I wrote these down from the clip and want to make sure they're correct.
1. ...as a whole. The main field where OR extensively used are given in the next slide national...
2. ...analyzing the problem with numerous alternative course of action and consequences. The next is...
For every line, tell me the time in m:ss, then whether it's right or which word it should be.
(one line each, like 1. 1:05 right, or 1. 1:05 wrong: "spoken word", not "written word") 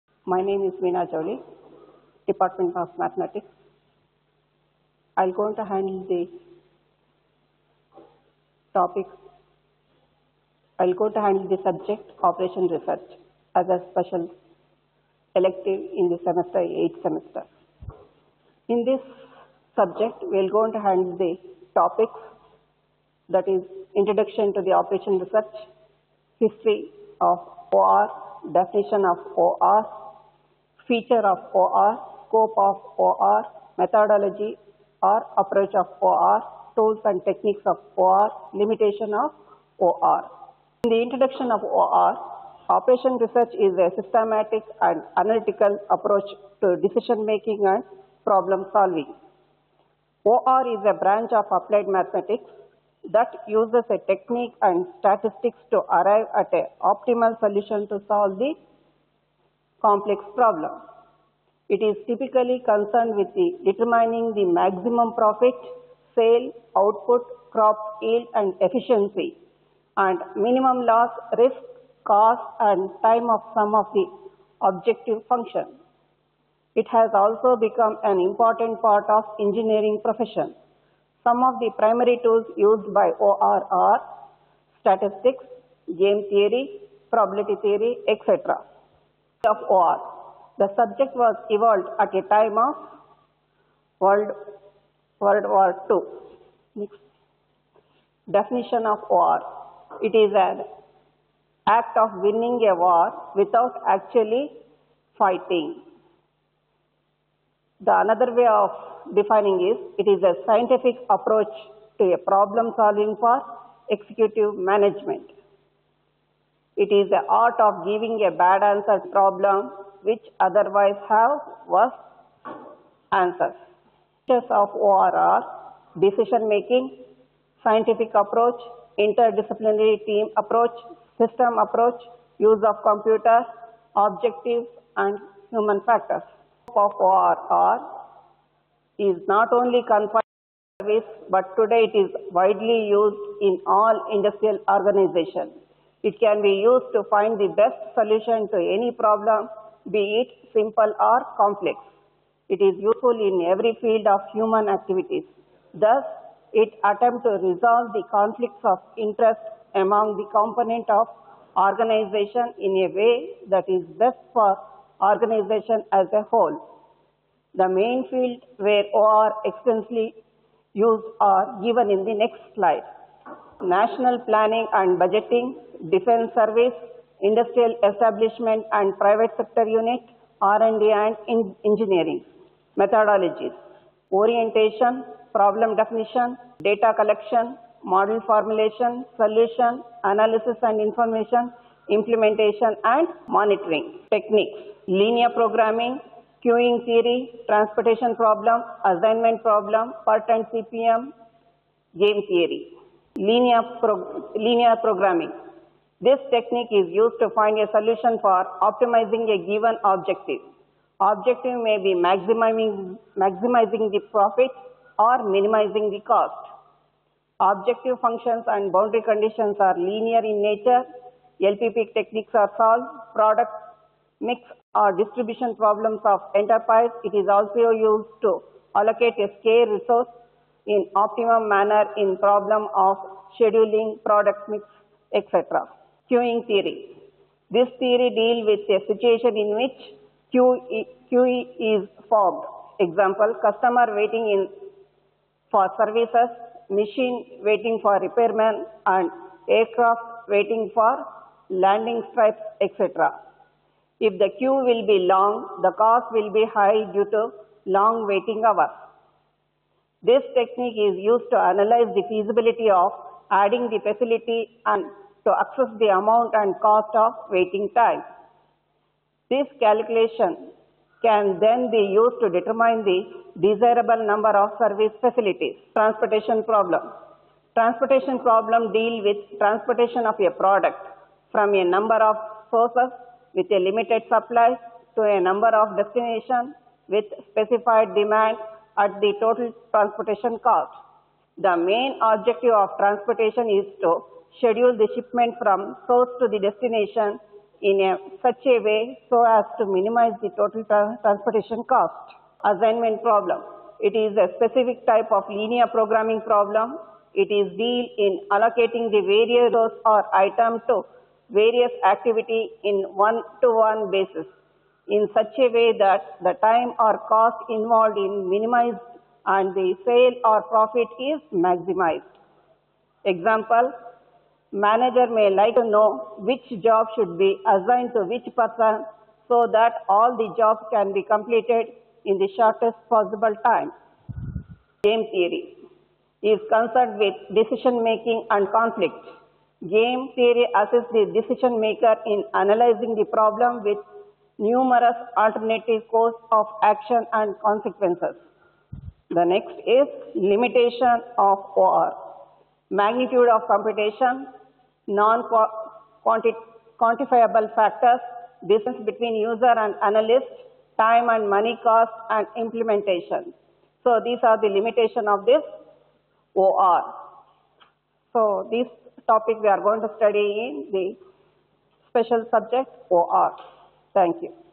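1. 2:45 right
2. 5:42 right.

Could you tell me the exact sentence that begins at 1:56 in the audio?
It is the art of giving a bad answer problem which otherwise have worse answers.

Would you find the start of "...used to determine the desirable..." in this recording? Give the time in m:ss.
4:31.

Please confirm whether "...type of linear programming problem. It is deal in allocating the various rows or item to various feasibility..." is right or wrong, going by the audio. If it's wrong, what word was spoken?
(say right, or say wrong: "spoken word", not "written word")
wrong: "activity", not "feasibility".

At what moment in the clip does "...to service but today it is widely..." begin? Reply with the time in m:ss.
2:20.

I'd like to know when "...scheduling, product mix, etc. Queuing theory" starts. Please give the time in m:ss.
3:53.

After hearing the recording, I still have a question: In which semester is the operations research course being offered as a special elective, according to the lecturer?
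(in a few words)
8th semester.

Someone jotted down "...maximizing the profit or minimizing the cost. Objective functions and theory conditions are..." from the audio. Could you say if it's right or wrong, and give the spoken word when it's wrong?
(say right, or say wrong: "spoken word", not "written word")
wrong: "boundary", not "theory".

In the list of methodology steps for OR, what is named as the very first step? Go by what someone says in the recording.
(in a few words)
Orientation.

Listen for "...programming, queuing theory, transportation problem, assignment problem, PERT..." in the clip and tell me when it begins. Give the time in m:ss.
3:15.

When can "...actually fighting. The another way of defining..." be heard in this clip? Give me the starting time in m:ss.
1:43.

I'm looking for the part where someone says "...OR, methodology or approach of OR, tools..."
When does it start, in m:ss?
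0:33.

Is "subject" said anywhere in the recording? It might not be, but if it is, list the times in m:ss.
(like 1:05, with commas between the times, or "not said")
0:11, 0:19, 1:30, 6:12.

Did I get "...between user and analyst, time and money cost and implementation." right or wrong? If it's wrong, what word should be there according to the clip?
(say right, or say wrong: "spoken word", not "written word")
right.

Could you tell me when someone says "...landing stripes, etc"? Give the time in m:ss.
4:11.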